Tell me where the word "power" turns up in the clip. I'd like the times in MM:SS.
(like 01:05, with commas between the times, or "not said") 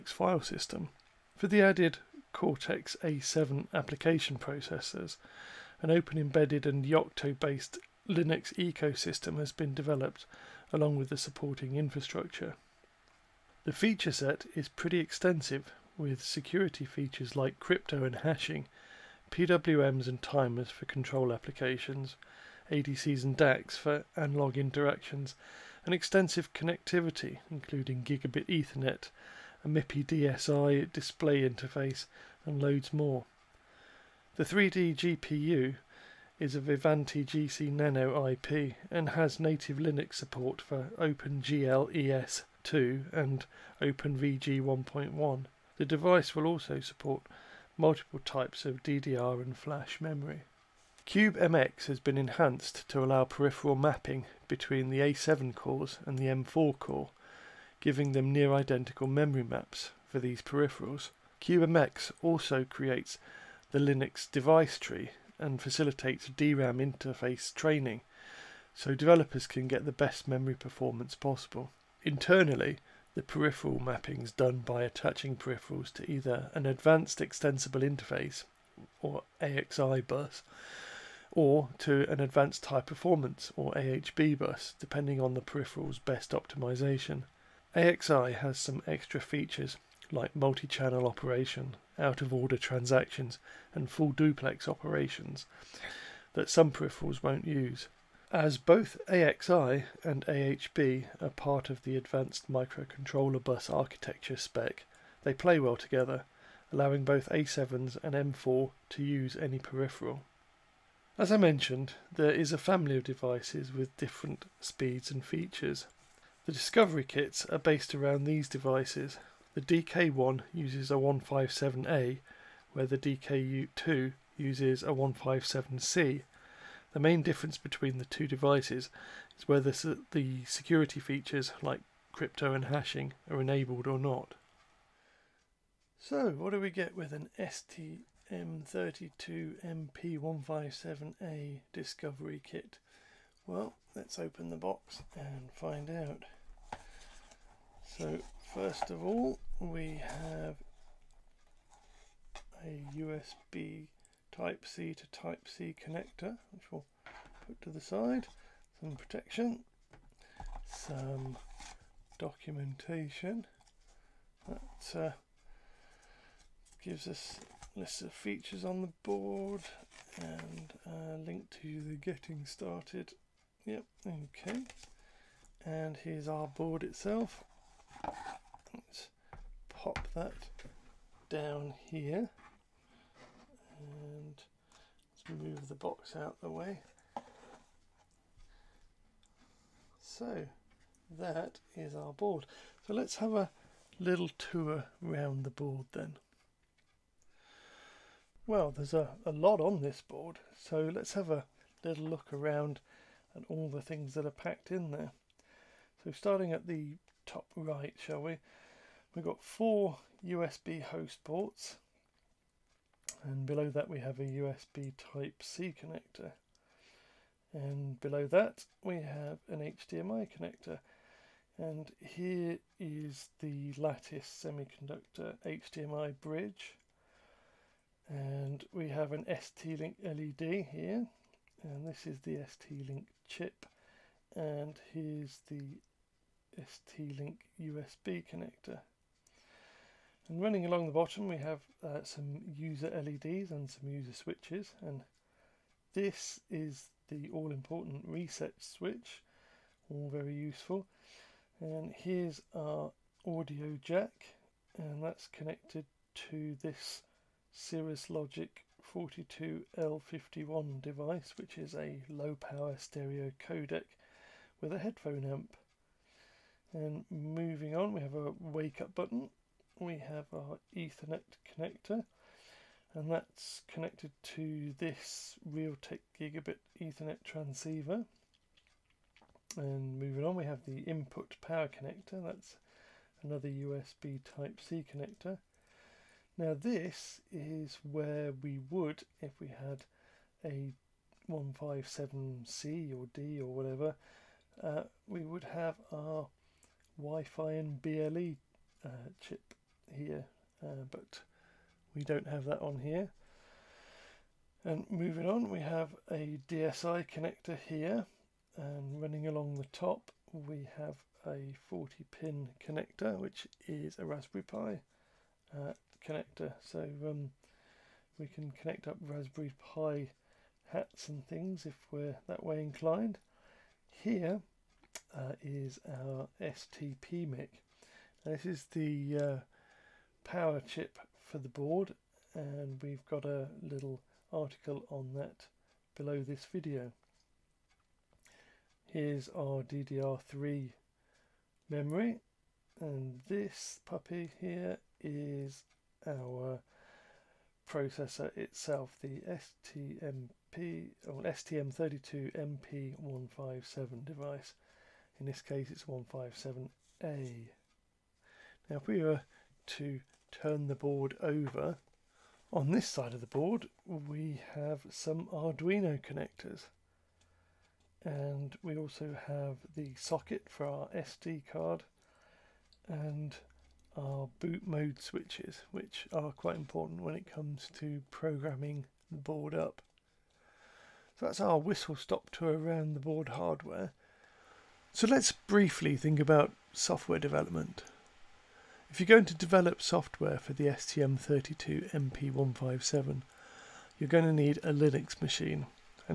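04:22, 04:41, 05:30.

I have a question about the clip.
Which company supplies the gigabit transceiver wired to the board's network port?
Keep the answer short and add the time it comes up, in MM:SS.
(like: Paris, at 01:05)
Realtek, at 04:35.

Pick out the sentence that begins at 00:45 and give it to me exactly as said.
The device will also support multiple types of DDR and flash memory.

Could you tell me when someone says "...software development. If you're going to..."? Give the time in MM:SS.
06:26.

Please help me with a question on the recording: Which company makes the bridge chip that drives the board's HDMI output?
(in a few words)
Lattice Semiconductor.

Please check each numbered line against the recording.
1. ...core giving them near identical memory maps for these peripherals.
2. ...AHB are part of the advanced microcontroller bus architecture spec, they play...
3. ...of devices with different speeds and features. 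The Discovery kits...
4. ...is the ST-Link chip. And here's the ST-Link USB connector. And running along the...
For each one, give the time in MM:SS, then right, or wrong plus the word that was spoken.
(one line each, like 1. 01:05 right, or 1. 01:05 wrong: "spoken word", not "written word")
1. 00:56 right
2. 01:40 right
3. 01:52 right
4. 03:52 right.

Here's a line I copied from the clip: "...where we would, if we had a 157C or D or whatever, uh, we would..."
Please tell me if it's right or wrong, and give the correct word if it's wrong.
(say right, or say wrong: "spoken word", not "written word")
right.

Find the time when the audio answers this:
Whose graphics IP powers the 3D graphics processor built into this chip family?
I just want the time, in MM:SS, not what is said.
00:36.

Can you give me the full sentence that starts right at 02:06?
The main difference between the two devices is whether the security features like crypto and hashing are enabled or not.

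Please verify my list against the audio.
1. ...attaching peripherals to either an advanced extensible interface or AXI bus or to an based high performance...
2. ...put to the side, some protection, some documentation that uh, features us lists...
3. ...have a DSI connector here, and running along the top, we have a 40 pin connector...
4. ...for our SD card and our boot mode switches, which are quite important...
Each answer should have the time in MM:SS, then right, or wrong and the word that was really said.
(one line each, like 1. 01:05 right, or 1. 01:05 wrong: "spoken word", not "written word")
1. 01:14 wrong: "advanced", not "based"
2. 02:37 wrong: "gives", not "features"
3. 05:05 right
4. 06:10 right.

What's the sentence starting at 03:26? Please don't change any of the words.
So starting at the top right, shall we?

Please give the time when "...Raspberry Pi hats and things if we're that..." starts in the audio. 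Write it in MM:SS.
05:18.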